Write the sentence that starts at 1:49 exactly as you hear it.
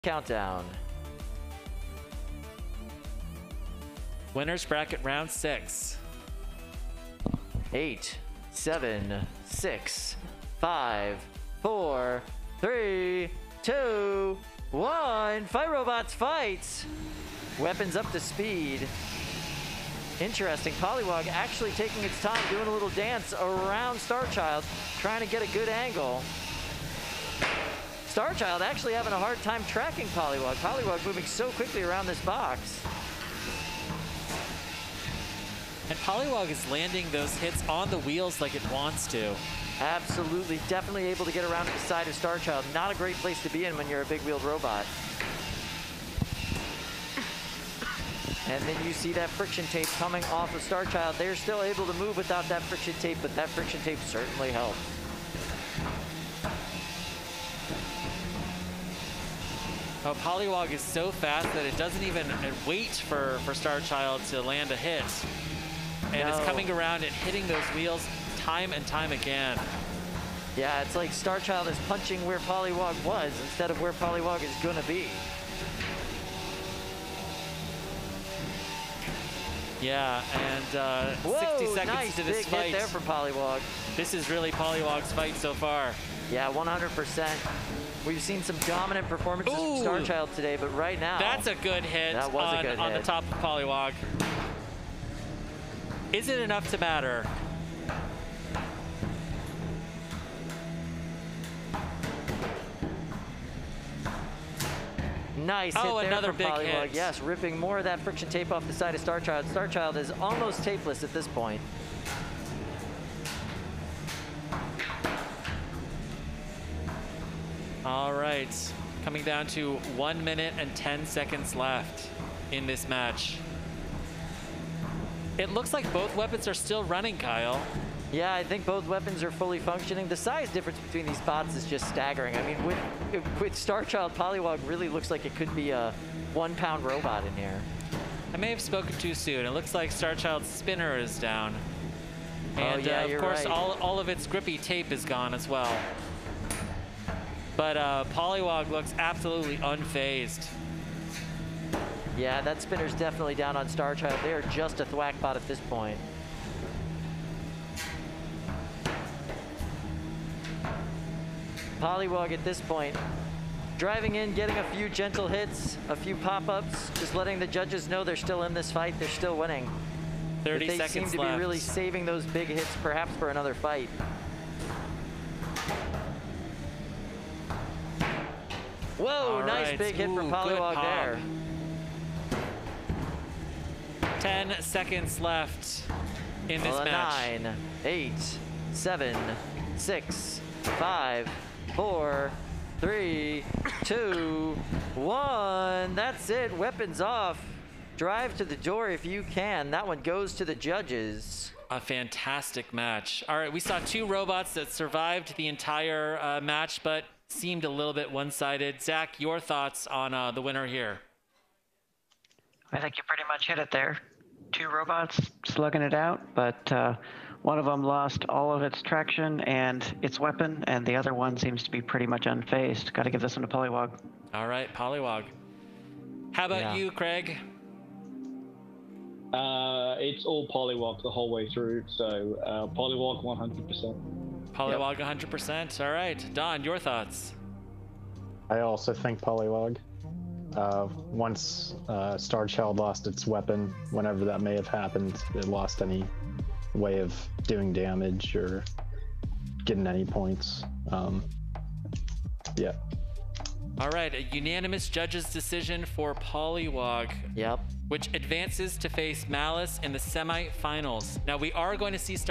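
Starchild is almost tapeless at this point.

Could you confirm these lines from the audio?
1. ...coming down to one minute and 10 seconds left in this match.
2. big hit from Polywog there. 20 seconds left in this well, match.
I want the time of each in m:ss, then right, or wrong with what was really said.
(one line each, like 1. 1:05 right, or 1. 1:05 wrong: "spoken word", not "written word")
1. 1:59 right
2. 2:59 wrong: "10", not "20".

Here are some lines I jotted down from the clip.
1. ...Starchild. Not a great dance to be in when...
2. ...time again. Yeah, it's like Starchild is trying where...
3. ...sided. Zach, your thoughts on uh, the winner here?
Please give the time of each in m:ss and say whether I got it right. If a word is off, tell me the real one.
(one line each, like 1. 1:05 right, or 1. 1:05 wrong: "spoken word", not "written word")
1. 0:42 wrong: "place", not "dance"
2. 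1:08 wrong: "punching", not "trying"
3. 3:28 right.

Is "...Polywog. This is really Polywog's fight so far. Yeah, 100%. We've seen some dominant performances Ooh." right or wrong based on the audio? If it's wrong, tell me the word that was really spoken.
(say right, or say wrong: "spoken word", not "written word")
right.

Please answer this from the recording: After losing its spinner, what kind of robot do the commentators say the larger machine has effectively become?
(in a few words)
A thwackbot.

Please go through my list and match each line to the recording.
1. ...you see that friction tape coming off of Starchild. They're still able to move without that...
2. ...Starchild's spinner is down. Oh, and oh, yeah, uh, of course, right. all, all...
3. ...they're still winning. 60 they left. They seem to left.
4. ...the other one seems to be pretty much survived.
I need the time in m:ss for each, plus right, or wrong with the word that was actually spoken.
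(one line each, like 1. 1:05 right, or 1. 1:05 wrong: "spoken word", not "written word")
1. 0:48 right
2. 2:19 right
3. 2:48 wrong: "30", not "60"
4. 3:40 wrong: "unfazed", not "survived".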